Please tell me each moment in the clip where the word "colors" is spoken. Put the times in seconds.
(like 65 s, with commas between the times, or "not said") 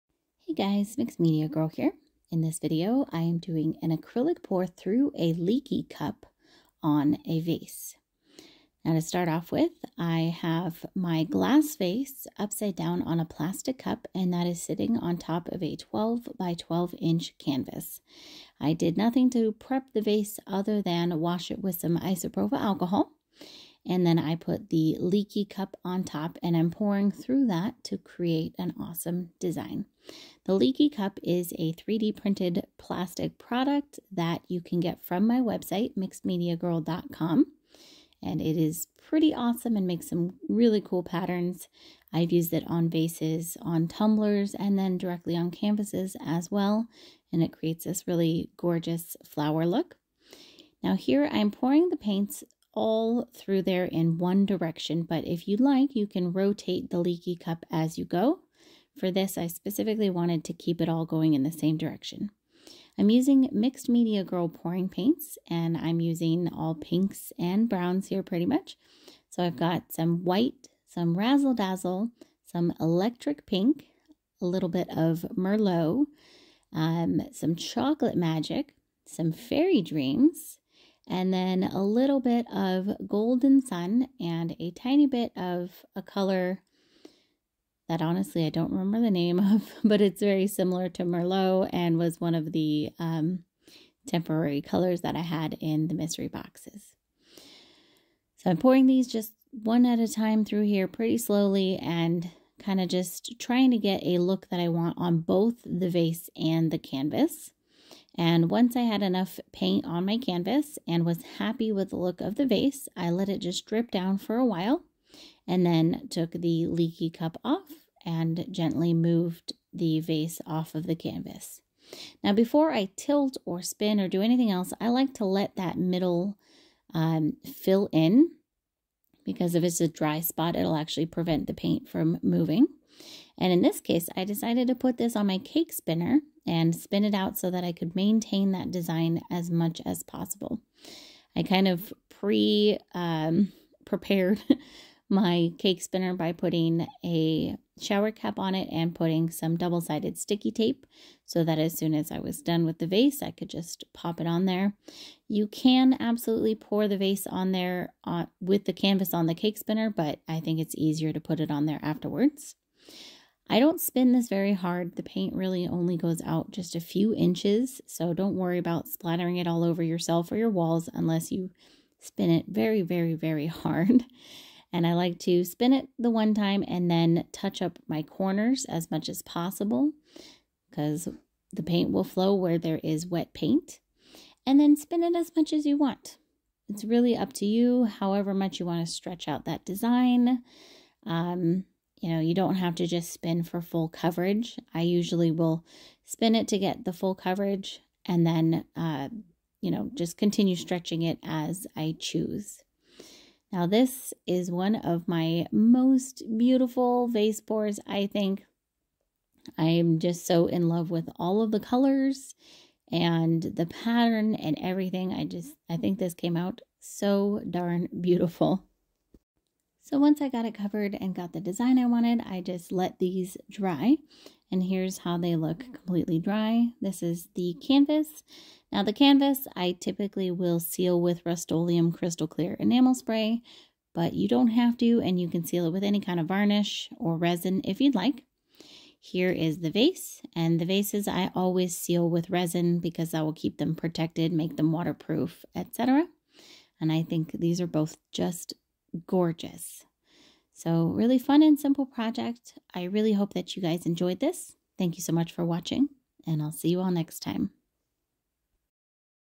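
86 s, 94 s, 211 s.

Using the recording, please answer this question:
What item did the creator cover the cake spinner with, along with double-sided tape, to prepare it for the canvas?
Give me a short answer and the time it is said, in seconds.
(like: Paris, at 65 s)
shower cap, at 147 s.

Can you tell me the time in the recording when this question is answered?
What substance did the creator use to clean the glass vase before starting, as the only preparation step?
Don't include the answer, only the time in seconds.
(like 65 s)
21 s.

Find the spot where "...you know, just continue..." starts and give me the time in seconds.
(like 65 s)
199 s.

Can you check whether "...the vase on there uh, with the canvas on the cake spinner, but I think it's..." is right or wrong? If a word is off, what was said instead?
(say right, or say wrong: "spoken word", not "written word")
right.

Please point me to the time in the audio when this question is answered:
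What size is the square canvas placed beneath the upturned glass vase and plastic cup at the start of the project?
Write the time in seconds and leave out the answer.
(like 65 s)
15 s.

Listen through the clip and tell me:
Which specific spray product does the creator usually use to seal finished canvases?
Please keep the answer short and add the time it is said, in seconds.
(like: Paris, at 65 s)
Rust-Oleum Crystal Clear Enamel Spray, at 231 s.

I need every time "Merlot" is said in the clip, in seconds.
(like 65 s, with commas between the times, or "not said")
75 s, 91 s.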